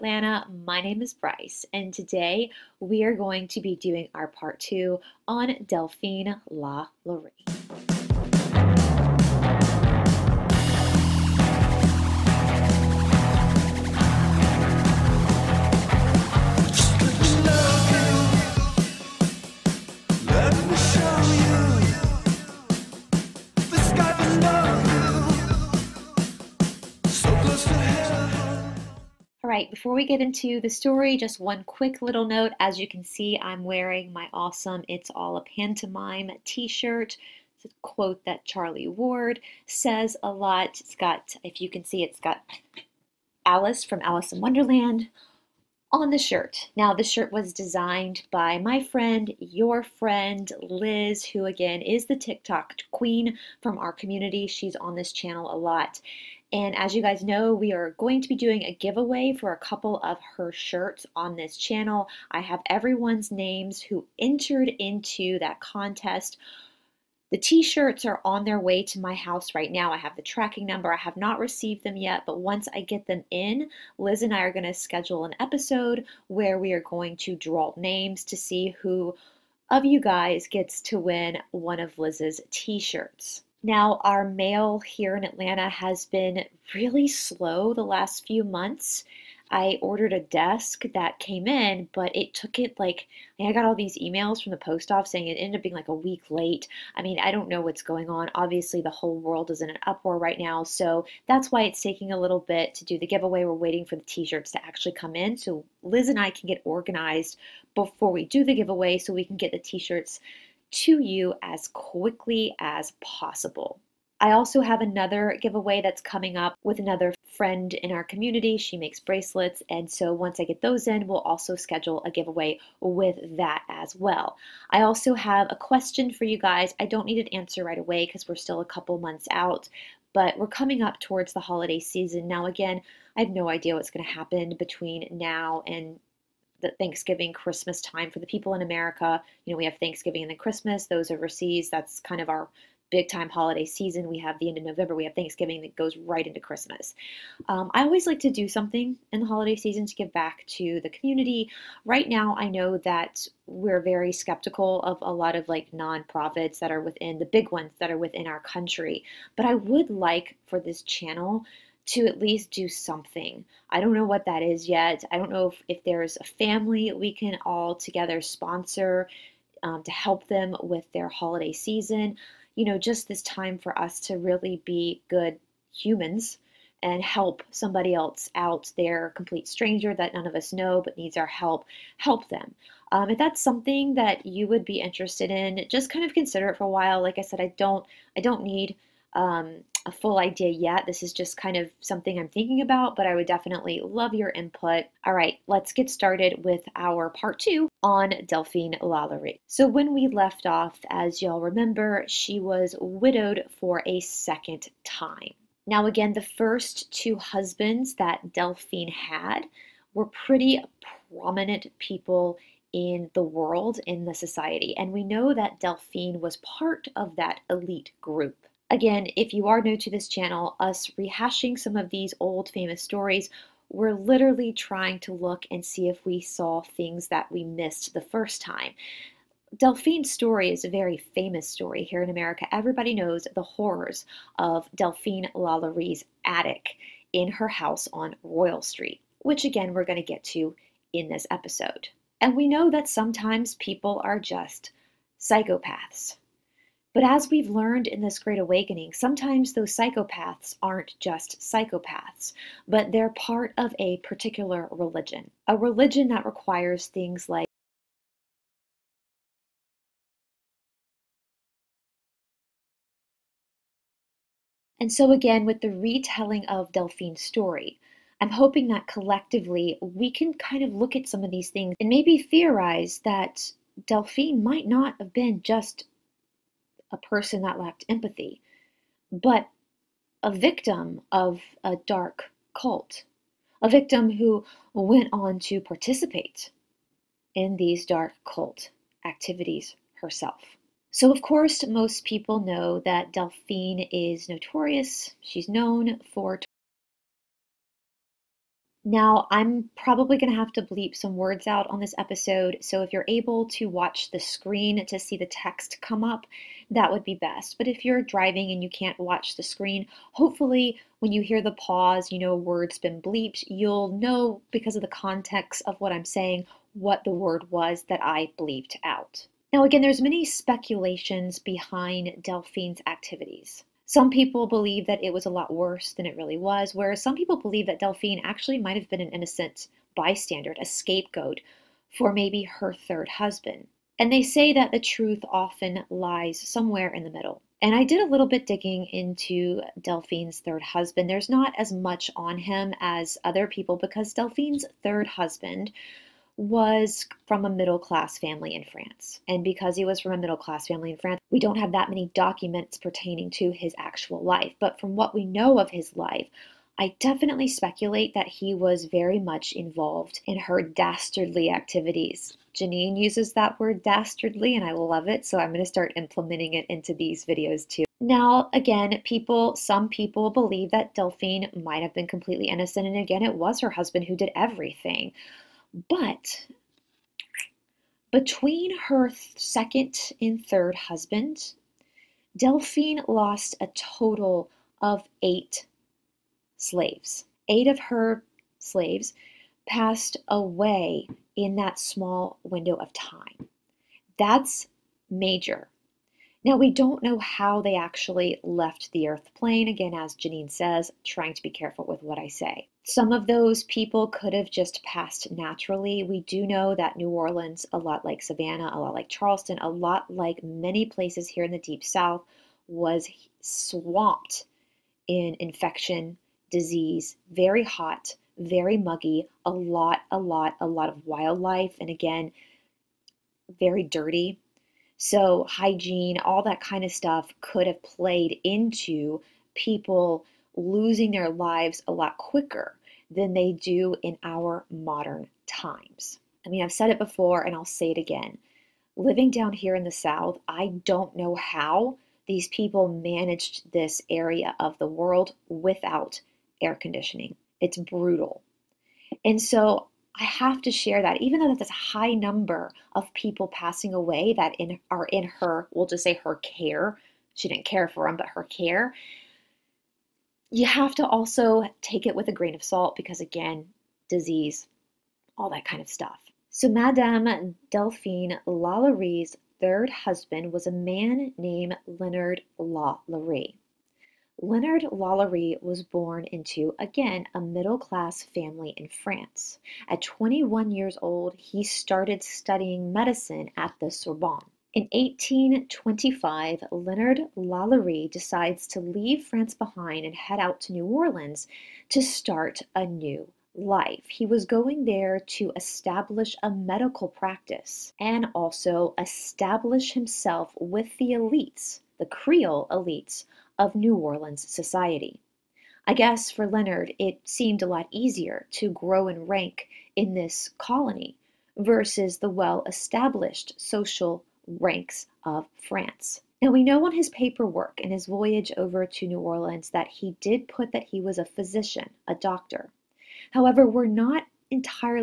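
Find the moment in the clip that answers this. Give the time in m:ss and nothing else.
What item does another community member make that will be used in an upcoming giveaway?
1:58.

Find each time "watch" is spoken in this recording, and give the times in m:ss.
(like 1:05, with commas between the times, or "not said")
5:03, 5:08.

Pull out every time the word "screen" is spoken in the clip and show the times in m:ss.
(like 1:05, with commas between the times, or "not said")
5:04, 5:09.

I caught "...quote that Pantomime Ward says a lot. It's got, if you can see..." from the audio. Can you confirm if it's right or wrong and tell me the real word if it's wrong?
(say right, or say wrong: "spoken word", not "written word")
wrong: "Charlie", not "Pantomime".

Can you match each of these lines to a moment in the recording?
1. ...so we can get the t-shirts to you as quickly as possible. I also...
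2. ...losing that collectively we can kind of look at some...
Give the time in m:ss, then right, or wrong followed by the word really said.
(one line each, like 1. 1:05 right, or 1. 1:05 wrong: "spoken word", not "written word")
1. 1:48 right
2. 4:28 wrong: "hoping", not "losing".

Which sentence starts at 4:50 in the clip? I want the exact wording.
So, of course, most people know that Delphine is notorious.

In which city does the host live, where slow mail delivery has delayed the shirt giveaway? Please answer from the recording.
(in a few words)
Atlanta.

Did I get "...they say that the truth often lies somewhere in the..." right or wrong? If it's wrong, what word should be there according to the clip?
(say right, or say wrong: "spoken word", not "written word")
right.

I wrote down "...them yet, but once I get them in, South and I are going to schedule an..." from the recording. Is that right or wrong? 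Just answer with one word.
wrong.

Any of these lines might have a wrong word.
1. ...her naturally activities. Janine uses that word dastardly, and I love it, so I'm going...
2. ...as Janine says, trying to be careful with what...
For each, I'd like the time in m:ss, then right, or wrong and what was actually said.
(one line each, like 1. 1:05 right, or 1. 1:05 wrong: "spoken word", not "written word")
1. 6:00 wrong: "dastardly", not "naturally"
2. 6:39 right.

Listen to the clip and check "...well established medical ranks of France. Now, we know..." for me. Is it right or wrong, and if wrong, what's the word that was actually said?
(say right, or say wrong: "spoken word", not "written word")
wrong: "social", not "medical".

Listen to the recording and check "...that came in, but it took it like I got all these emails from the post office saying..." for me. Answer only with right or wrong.
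right.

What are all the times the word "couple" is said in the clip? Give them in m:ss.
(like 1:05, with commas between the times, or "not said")
0:59, 2:08.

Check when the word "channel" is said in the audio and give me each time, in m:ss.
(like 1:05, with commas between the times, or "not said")
0:55, 1:01, 2:40, 3:40.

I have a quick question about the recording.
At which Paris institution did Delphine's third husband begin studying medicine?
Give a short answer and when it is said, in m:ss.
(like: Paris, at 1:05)
The Sorbonne, at 8:03.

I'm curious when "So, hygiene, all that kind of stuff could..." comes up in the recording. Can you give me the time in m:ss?
7:04.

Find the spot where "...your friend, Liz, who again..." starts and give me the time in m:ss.
0:49.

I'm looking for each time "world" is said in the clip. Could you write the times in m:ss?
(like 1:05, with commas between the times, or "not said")
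1:39, 3:33, 7:24.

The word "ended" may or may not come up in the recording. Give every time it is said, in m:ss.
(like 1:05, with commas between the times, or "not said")
1:35.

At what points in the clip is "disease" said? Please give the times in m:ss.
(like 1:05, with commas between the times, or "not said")
6:56, 7:44.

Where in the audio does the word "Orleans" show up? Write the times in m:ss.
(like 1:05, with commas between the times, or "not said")
6:47, 8:10, 8:23, 8:39.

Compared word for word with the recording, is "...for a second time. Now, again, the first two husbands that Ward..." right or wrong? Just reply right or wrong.
wrong.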